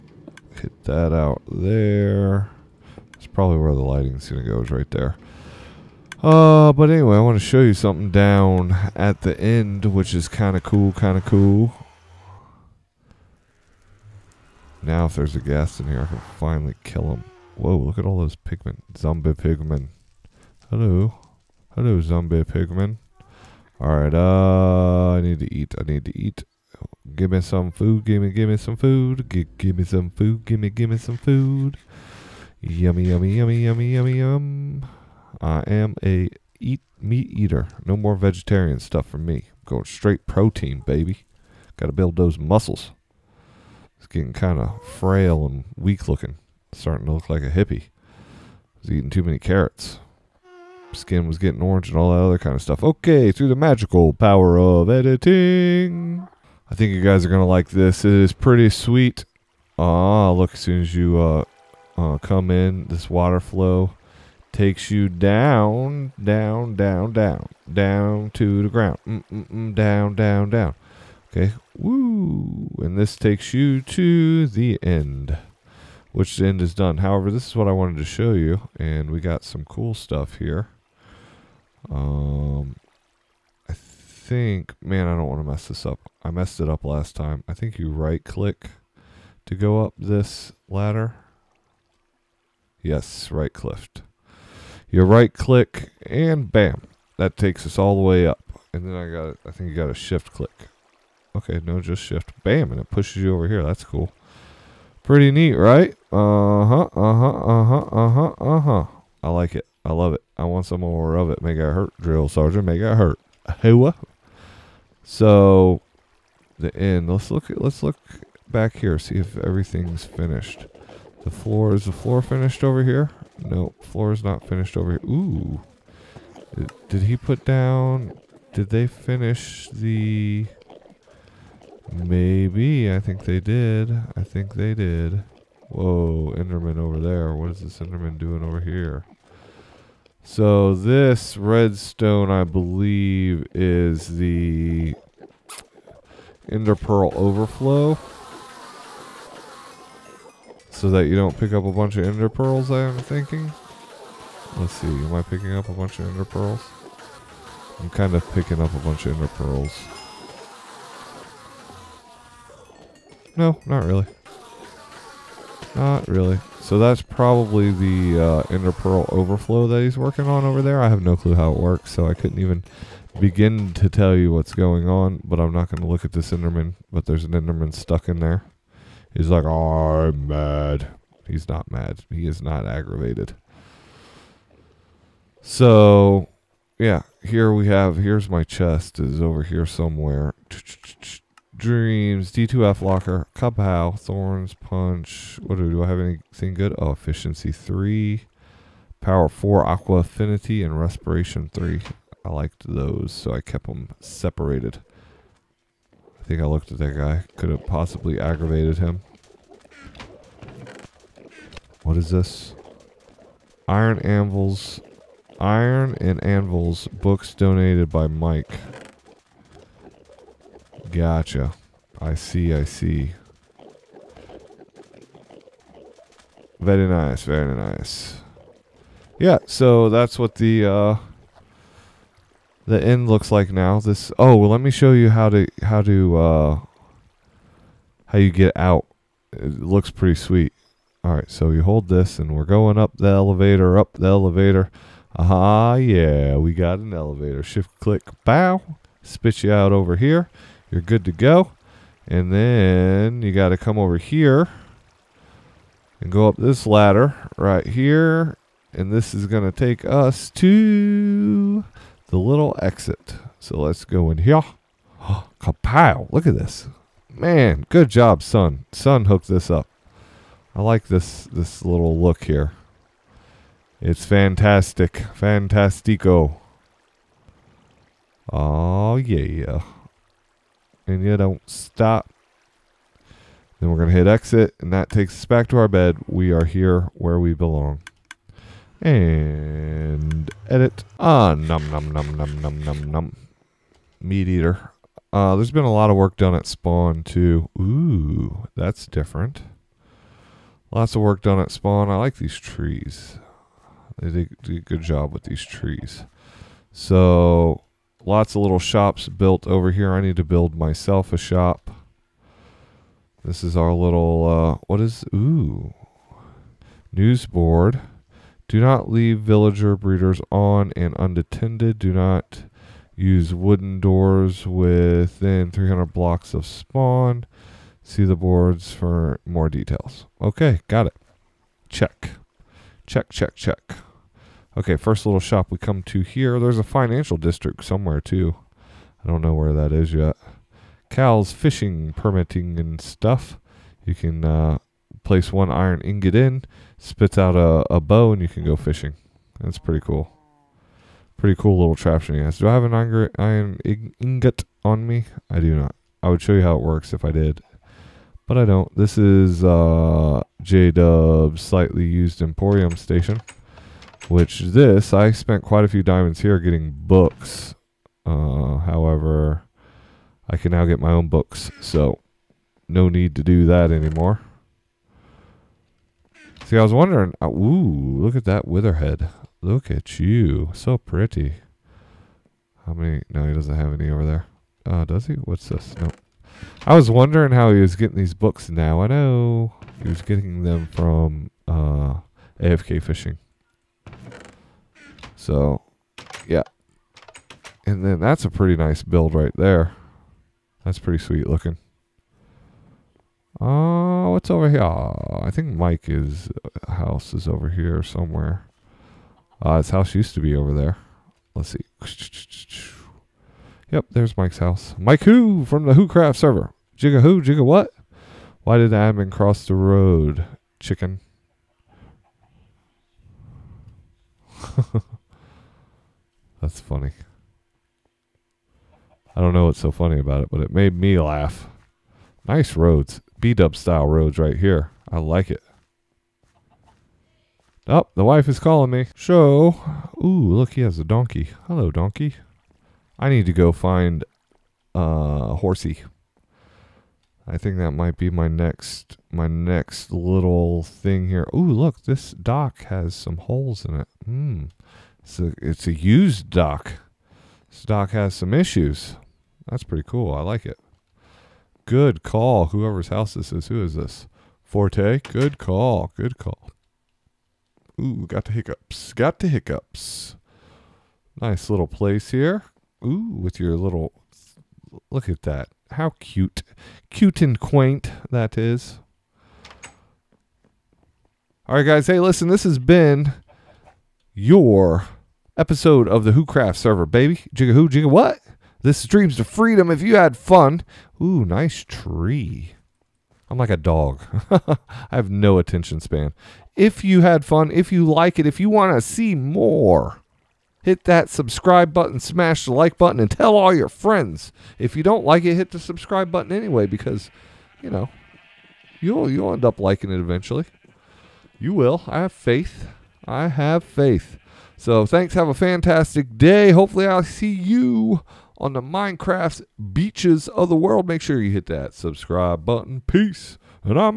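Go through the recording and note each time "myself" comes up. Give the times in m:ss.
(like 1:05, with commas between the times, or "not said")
5:10.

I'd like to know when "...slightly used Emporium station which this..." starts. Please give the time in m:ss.
6:01.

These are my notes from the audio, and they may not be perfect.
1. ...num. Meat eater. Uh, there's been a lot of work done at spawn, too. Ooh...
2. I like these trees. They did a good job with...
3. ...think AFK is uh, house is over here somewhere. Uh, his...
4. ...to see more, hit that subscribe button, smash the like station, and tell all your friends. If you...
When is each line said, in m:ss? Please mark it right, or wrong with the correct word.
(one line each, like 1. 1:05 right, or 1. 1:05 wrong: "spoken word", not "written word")
1. 4:52 right
2. 5:01 right
3. 6:45 wrong: "Mike", not "AFK"
4. 8:18 wrong: "button", not "station".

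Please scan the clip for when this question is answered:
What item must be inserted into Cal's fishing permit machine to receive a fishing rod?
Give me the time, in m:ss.
5:45.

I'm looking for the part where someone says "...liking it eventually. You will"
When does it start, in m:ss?
8:29.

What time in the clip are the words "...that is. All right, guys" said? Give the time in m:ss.
7:58.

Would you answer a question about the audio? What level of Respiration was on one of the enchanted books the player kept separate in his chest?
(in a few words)
3.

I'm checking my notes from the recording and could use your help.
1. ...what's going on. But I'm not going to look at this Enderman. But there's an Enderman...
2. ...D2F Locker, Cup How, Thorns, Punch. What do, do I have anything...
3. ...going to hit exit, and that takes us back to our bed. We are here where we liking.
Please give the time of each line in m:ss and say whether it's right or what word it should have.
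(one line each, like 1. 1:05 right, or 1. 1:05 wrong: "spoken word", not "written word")
1. 2:54 right
2. 3:12 right
3. 4:43 wrong: "belong", not "liking".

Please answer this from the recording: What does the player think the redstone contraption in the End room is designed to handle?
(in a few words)
Enderpearl overflow.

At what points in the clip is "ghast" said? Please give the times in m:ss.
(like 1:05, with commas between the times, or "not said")
0:15.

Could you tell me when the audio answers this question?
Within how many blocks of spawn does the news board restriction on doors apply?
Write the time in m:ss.
5:25.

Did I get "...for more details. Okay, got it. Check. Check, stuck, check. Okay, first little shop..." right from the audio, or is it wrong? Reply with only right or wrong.
wrong.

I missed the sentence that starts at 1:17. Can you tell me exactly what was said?
However, this is what I wanted to show you, and we got some cool stuff here.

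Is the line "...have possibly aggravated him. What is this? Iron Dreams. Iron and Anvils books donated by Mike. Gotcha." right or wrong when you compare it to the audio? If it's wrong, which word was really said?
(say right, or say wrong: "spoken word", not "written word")
wrong: "Anvils", not "Dreams".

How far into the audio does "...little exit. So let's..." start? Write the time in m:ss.
4:22.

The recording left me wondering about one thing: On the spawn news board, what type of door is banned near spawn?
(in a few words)
Wooden doors.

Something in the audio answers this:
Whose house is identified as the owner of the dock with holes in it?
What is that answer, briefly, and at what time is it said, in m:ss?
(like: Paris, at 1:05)
Forte, at 7:44.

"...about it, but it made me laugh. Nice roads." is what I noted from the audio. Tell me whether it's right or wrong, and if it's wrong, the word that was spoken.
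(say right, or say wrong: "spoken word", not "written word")
right.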